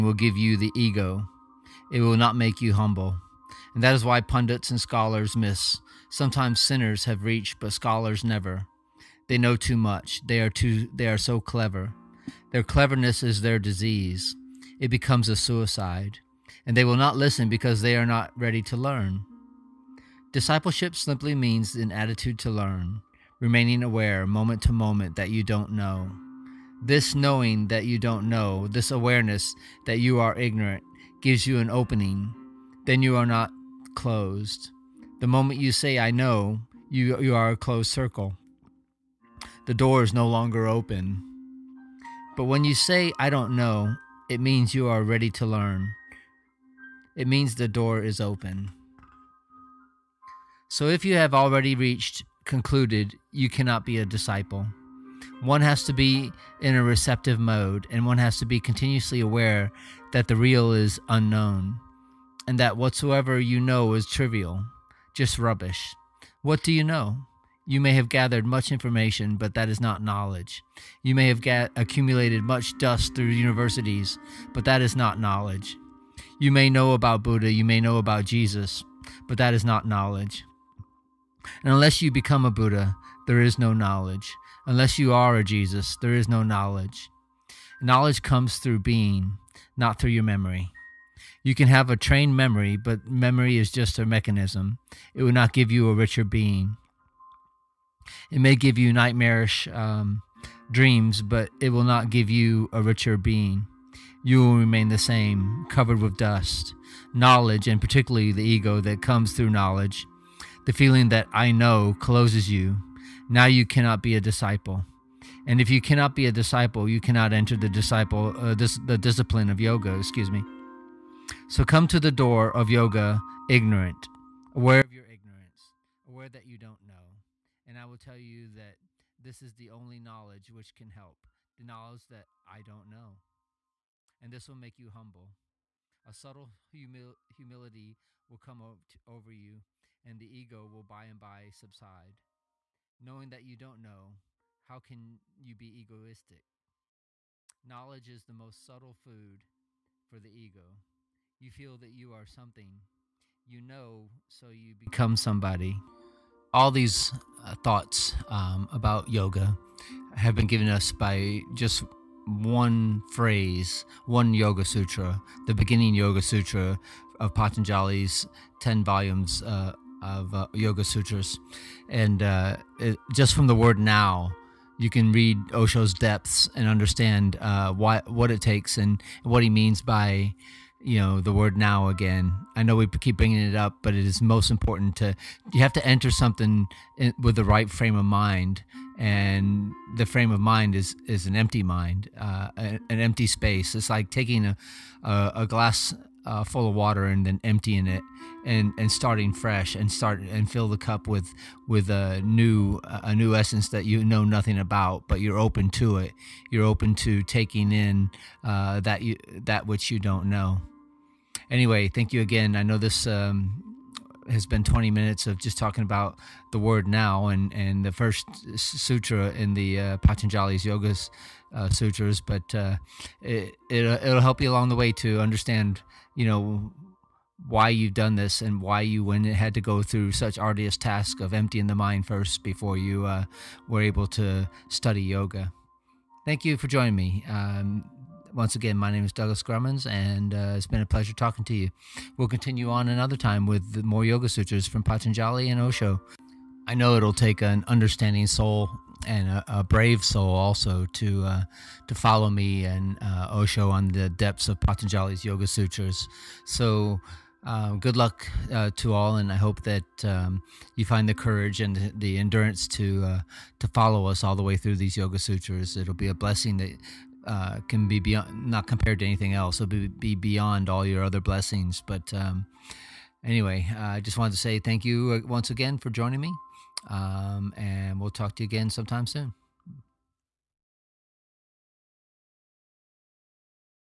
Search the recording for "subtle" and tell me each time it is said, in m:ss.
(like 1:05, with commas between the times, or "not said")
2:16, 2:28.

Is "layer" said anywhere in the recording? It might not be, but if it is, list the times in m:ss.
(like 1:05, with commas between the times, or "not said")
not said.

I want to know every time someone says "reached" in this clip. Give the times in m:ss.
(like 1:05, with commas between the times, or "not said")
0:07, 0:51.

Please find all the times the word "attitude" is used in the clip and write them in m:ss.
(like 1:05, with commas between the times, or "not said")
0:21.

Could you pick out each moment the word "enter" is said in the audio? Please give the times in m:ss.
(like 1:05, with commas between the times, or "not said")
1:57, 3:05.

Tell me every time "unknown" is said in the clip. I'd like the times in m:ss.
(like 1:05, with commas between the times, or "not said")
1:01.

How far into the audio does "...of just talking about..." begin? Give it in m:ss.
3:35.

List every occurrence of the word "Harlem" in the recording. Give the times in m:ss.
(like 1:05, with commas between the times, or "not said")
not said.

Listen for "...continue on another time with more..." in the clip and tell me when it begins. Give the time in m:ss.
4:02.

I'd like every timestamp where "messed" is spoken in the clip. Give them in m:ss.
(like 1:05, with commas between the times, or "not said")
not said.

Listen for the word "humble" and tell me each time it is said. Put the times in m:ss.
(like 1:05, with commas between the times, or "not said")
0:02, 2:14.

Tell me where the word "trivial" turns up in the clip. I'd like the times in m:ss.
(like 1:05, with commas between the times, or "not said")
1:04.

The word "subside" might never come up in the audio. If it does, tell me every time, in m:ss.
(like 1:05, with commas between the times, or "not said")
2:21.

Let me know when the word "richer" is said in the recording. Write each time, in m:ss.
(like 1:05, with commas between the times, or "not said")
1:35, 1:42.